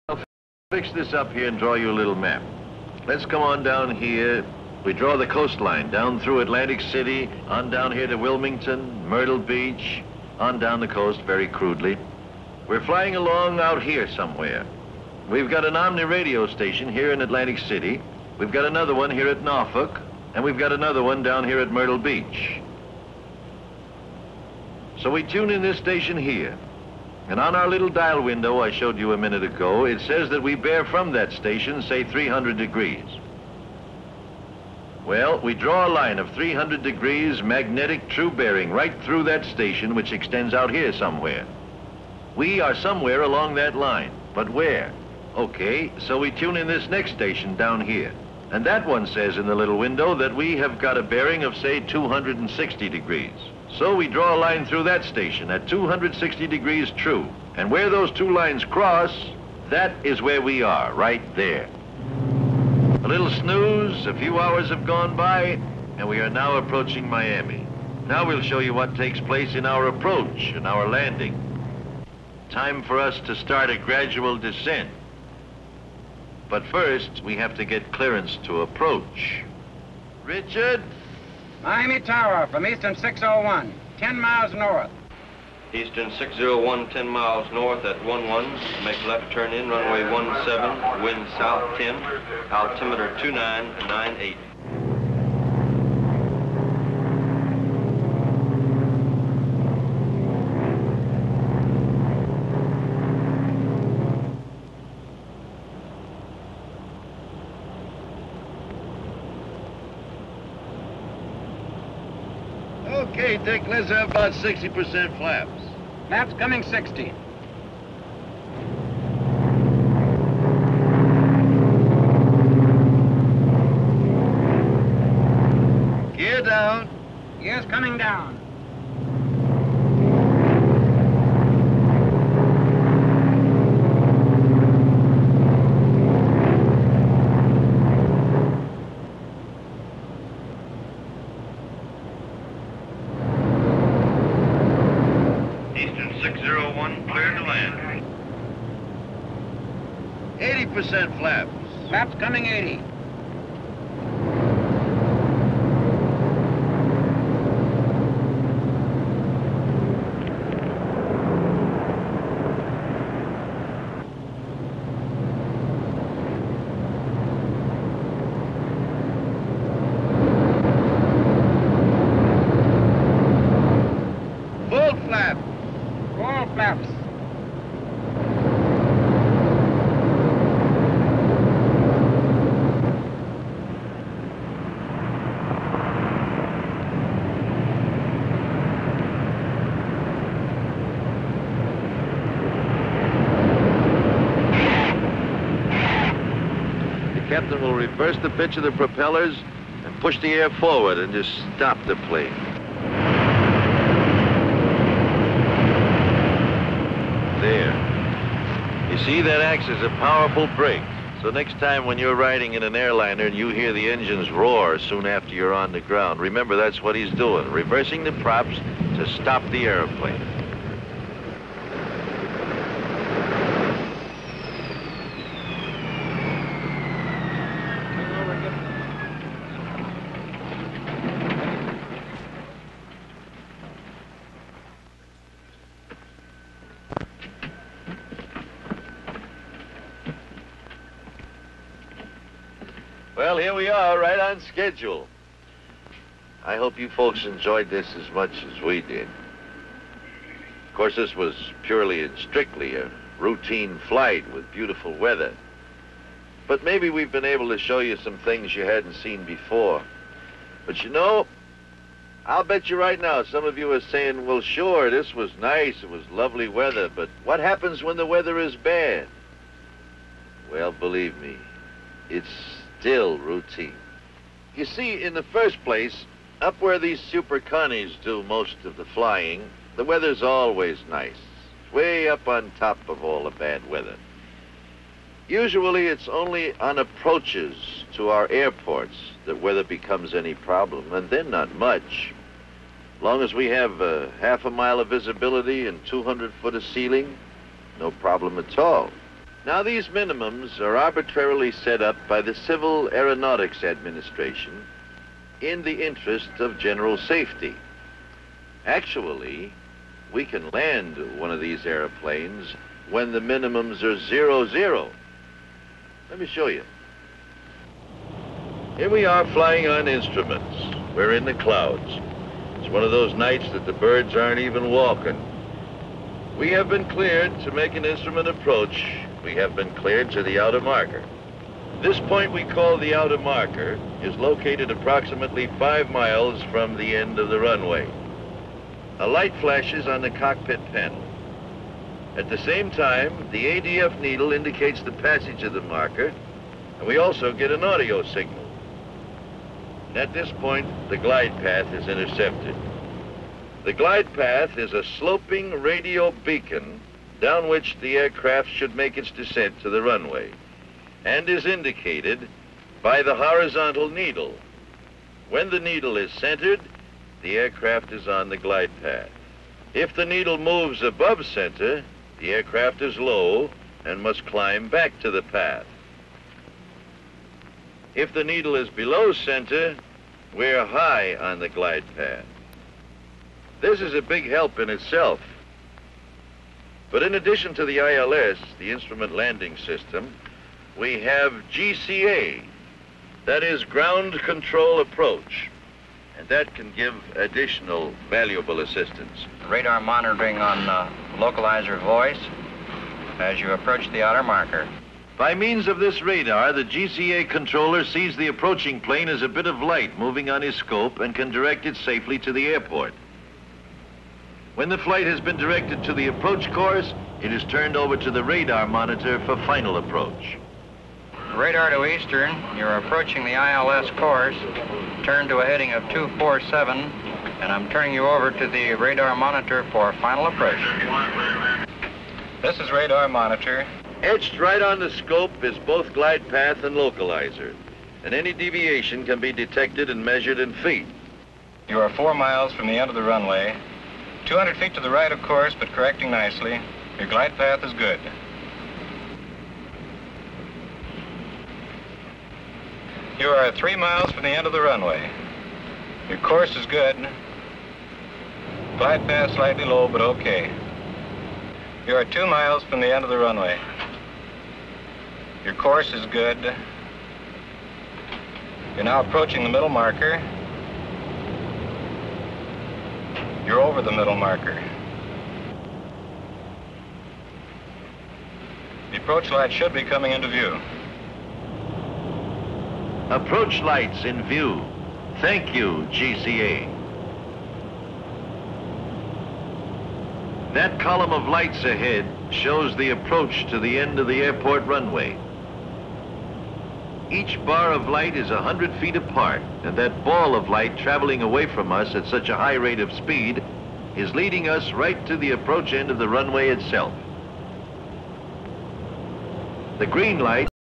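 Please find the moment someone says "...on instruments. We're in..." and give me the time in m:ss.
5:19.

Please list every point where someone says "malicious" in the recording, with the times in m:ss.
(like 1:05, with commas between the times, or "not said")
not said.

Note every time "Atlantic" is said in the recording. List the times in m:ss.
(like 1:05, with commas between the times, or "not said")
0:06, 0:17.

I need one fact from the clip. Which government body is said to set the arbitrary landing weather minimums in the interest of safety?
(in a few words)
Civil Aeronautics Administration.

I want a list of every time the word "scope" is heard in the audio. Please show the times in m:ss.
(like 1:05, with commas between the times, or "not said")
6:50, 7:14.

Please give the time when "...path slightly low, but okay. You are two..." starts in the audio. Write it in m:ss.
7:39.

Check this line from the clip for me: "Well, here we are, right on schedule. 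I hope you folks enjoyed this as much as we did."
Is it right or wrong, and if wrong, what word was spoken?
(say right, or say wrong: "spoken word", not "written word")
right.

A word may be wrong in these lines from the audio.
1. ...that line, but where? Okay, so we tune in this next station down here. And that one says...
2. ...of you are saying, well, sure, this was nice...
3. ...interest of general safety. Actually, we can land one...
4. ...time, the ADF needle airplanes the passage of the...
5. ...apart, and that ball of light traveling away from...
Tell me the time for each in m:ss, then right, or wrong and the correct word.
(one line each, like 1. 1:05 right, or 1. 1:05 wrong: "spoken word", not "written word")
1. 0:43 right
2. 4:23 right
3. 5:05 right
4. 5:42 wrong: "indicates", not "airplanes"
5. 8:18 right.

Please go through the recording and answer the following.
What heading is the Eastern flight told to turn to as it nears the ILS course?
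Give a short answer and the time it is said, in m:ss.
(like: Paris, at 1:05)
247, at 7:05.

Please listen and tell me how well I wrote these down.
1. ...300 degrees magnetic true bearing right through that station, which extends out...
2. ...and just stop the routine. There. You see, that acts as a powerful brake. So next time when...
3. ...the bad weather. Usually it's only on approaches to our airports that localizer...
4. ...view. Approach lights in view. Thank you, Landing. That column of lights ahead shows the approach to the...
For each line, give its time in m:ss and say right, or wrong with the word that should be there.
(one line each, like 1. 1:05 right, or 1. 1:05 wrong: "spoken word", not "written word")
1. 0:36 right
2. 3:20 wrong: "plane", not "routine"
3. 4:43 wrong: "weather", not "localizer"
4. 8:00 wrong: "GCA", not "Landing".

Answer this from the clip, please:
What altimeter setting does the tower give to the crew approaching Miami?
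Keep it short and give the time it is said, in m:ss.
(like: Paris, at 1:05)
2998, at 1:32.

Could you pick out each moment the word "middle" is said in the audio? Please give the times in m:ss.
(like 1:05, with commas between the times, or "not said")
7:49, 7:53.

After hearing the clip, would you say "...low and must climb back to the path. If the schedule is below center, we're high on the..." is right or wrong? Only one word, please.
wrong.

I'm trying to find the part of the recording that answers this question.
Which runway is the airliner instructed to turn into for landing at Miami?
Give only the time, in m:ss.
1:29.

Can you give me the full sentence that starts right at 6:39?
Radar monitoring on uh, localizer voice as you approach the outer marker.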